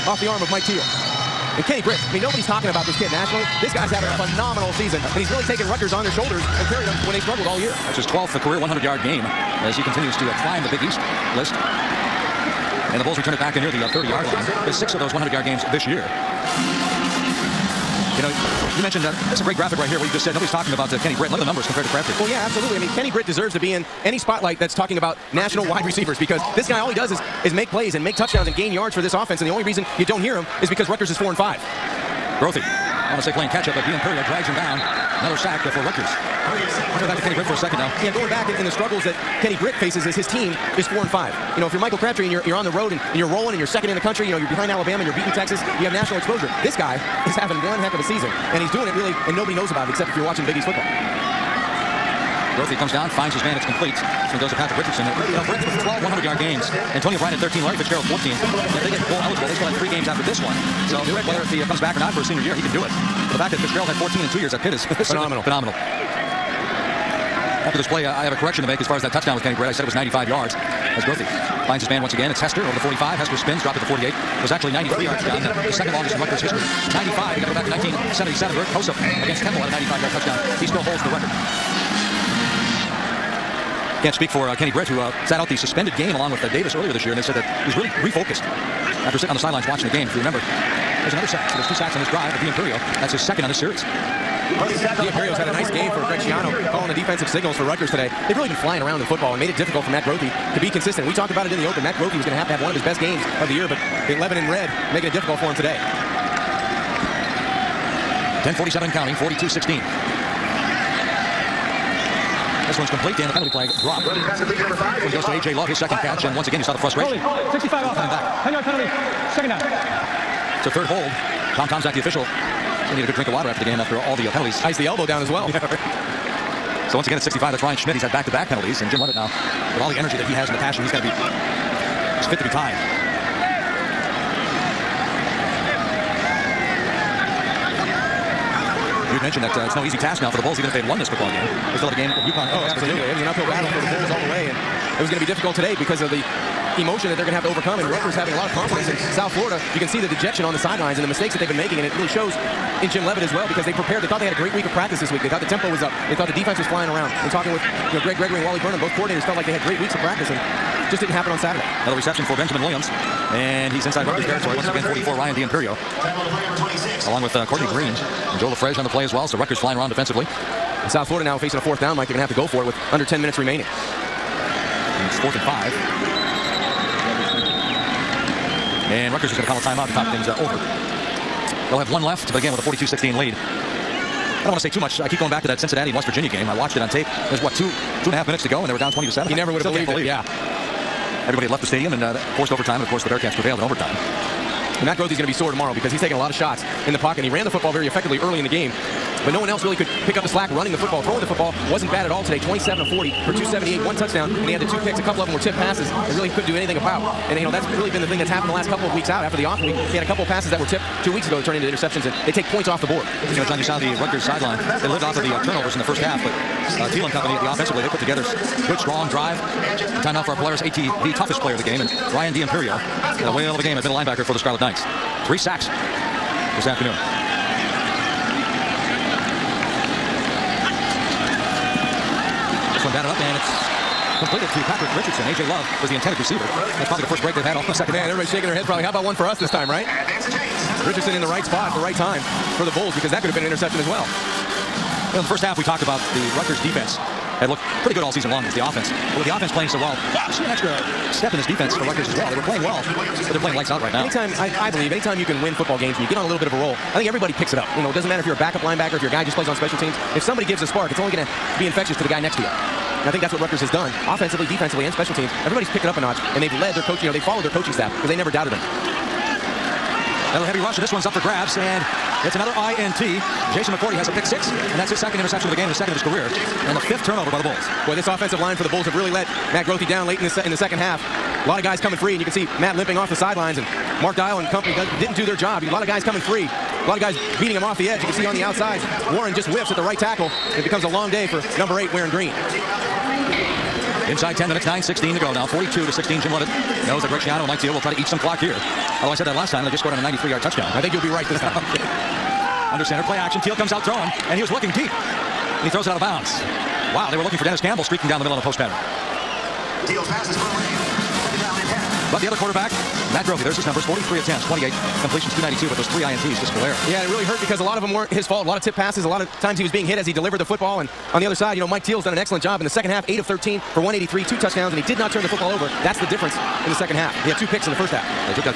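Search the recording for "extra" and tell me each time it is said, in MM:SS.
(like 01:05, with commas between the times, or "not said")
04:10.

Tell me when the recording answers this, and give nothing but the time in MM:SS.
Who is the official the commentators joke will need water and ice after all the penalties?
02:01.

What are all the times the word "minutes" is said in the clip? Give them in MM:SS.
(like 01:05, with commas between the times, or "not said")
02:53, 03:08, 04:54.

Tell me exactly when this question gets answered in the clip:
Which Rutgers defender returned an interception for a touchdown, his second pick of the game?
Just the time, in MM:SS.
04:33.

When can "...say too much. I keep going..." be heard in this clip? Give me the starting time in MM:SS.
03:04.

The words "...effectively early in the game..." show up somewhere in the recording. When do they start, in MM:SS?
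03:17.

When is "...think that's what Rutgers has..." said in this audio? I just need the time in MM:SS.
04:23.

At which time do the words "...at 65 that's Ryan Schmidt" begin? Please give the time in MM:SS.
02:07.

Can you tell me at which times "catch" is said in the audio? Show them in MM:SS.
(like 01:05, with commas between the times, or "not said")
00:33, 01:56.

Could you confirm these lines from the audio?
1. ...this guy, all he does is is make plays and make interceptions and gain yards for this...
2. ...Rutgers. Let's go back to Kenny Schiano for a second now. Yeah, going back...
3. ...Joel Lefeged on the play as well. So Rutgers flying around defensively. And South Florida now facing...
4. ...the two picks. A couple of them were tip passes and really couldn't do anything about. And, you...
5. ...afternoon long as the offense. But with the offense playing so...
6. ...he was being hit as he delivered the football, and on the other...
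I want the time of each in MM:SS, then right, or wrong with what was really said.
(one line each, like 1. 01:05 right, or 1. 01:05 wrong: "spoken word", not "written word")
1. 00:26 wrong: "touchdowns", not "interceptions"
2. 00:35 wrong: "Britt", not "Schiano"
3. 02:48 right
4. 03:24 right
5. 04:08 wrong: "season", not "afternoon"
6. 05:19 right.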